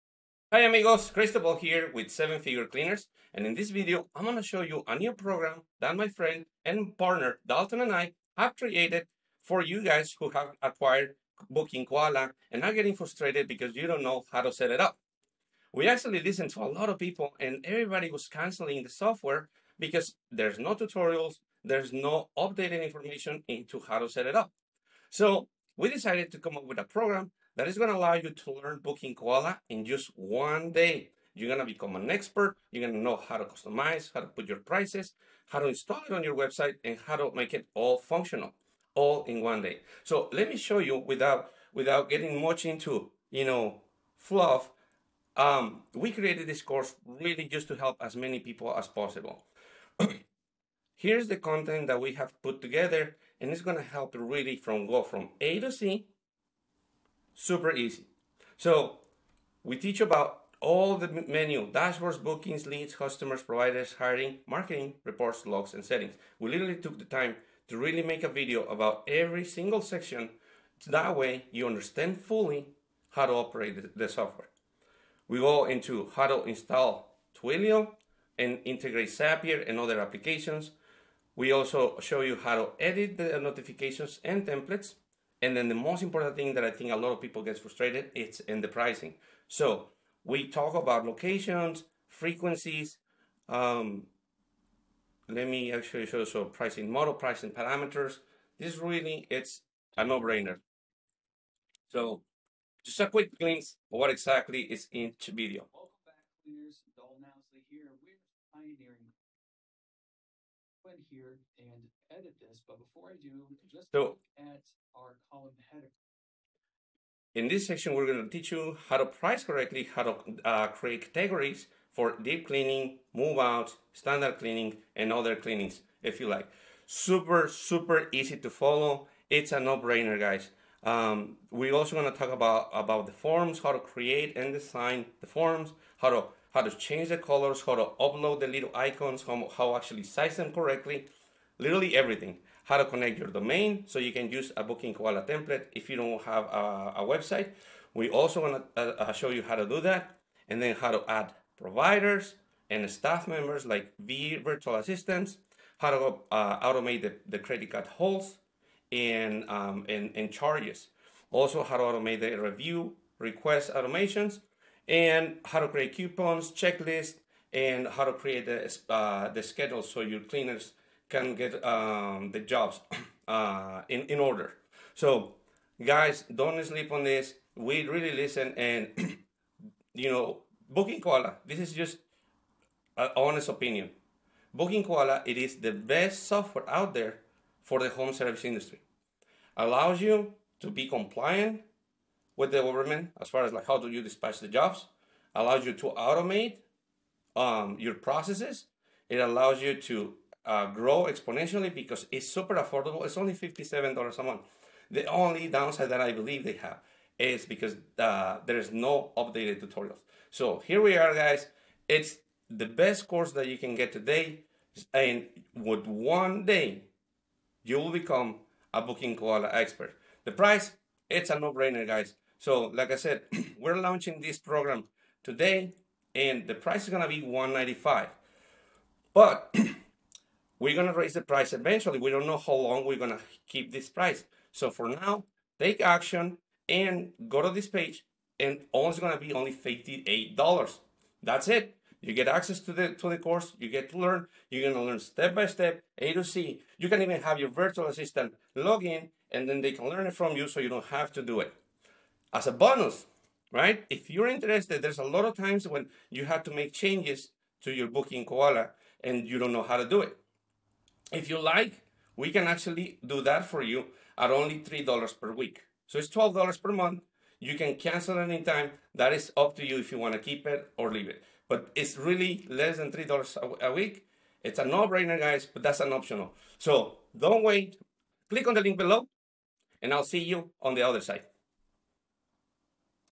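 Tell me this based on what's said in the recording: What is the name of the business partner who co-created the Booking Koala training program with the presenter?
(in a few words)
Dalton.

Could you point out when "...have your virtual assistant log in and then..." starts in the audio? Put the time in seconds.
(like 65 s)
247 s.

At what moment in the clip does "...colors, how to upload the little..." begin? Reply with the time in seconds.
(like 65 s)
137 s.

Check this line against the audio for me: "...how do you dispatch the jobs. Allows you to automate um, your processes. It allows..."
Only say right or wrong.
right.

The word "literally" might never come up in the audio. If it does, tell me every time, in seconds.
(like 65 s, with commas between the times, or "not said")
66 s, 141 s.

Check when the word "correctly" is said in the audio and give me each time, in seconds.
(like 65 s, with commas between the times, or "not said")
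119 s, 140 s.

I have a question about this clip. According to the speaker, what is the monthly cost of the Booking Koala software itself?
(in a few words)
$57.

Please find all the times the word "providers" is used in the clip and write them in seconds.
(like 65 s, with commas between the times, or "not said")
63 s, 151 s.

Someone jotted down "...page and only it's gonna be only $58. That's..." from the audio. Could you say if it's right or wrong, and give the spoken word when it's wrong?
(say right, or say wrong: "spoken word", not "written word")
right.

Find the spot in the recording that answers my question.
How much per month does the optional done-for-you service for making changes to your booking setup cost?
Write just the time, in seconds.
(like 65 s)
266 s.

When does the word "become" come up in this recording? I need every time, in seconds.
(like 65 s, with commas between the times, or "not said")
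31 s, 218 s.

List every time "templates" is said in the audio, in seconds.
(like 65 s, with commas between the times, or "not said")
84 s, 145 s.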